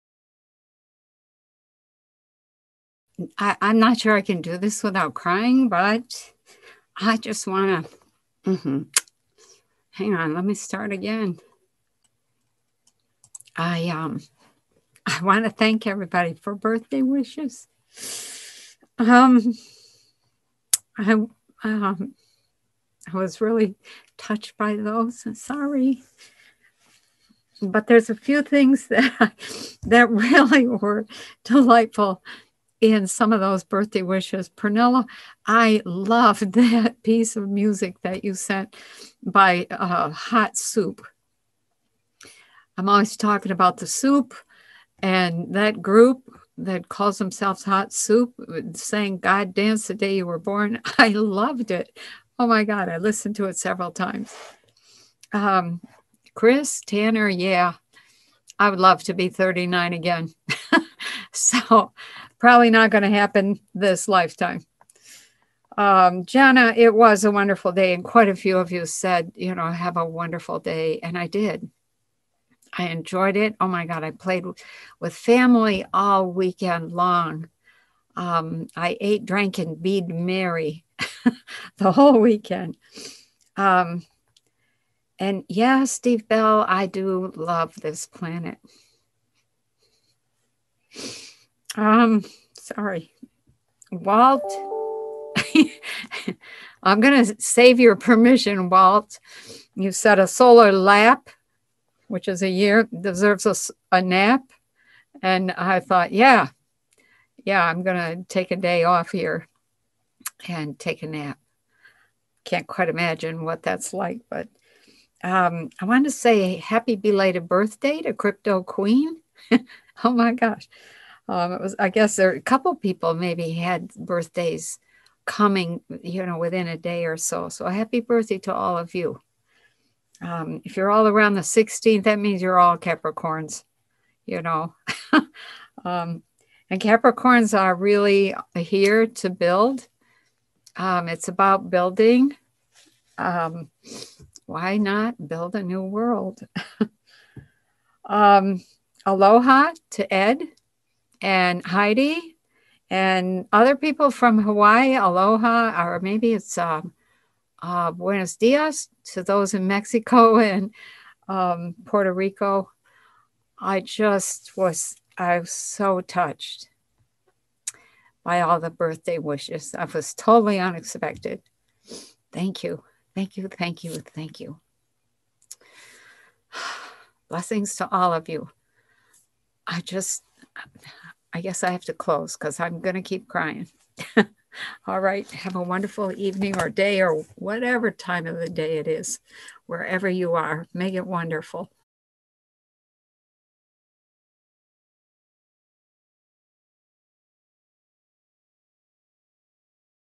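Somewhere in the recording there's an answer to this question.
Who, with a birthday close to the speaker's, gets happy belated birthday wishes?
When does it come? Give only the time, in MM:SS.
01:58.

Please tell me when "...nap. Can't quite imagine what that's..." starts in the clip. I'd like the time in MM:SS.
01:51.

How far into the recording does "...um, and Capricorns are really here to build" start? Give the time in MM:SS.
02:15.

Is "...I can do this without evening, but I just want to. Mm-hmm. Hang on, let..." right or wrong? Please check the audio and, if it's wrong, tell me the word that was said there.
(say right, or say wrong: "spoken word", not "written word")
wrong: "crying", not "evening".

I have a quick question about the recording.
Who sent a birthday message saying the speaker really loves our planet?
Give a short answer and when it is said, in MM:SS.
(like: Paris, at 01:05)
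Steve Bell, at 01:25.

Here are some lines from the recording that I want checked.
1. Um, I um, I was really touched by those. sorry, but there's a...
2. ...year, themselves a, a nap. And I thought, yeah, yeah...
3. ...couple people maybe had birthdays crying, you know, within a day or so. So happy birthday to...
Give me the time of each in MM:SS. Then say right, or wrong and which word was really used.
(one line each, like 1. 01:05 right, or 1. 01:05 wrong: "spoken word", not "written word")
1. 00:18 right
2. 01:42 wrong: "deserves", not "themselves"
3. 02:02 wrong: "coming", not "crying".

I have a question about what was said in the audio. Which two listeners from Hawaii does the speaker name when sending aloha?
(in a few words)
Ed and Heidi.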